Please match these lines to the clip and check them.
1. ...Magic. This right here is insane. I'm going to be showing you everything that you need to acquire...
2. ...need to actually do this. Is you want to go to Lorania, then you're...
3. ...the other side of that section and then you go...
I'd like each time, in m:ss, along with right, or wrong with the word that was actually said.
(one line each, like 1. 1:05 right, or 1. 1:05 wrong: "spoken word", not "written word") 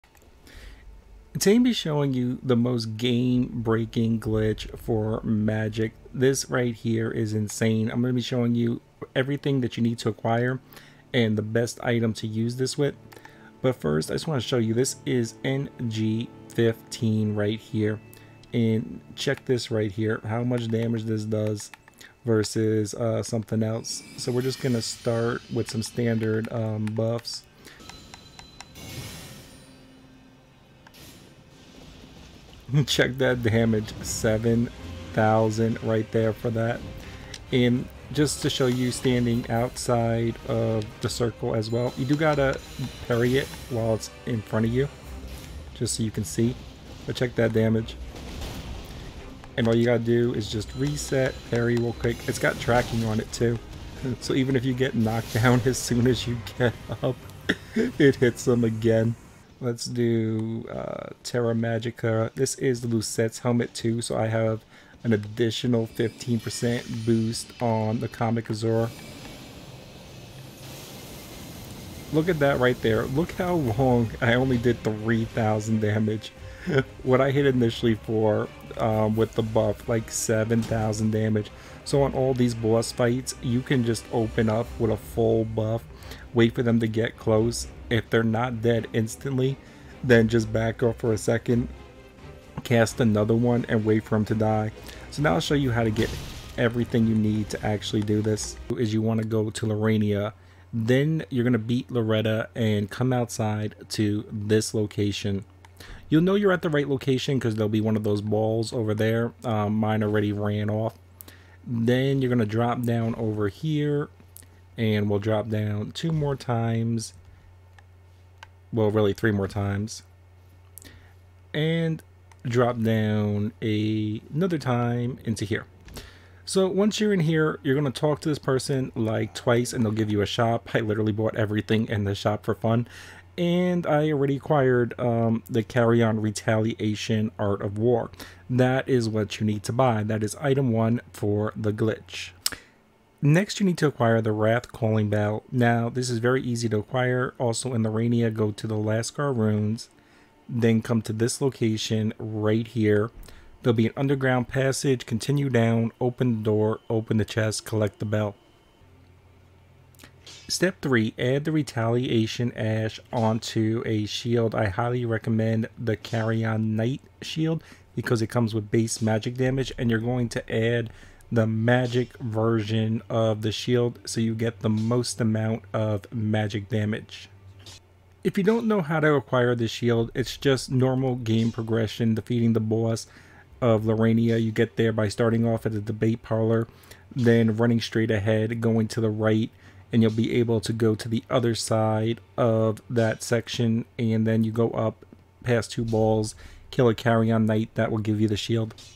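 1. 0:05 right
2. 1:37 right
3. 3:11 right.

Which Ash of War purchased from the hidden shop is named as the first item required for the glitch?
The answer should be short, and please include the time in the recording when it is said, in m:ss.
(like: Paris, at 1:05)
Carian Retaliation, at 2:15.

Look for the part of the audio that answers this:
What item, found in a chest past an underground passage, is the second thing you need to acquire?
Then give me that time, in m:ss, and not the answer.
2:24.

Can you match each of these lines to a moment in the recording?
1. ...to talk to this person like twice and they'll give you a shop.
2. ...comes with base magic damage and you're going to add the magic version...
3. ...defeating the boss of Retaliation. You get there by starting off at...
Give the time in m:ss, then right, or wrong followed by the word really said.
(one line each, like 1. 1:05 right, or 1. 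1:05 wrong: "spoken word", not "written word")
1. 2:07 right
2. 2:48 right
3. 3:02 wrong: "Lorania", not "Retaliation".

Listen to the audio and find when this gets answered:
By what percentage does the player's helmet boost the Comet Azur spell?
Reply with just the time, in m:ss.
1:05.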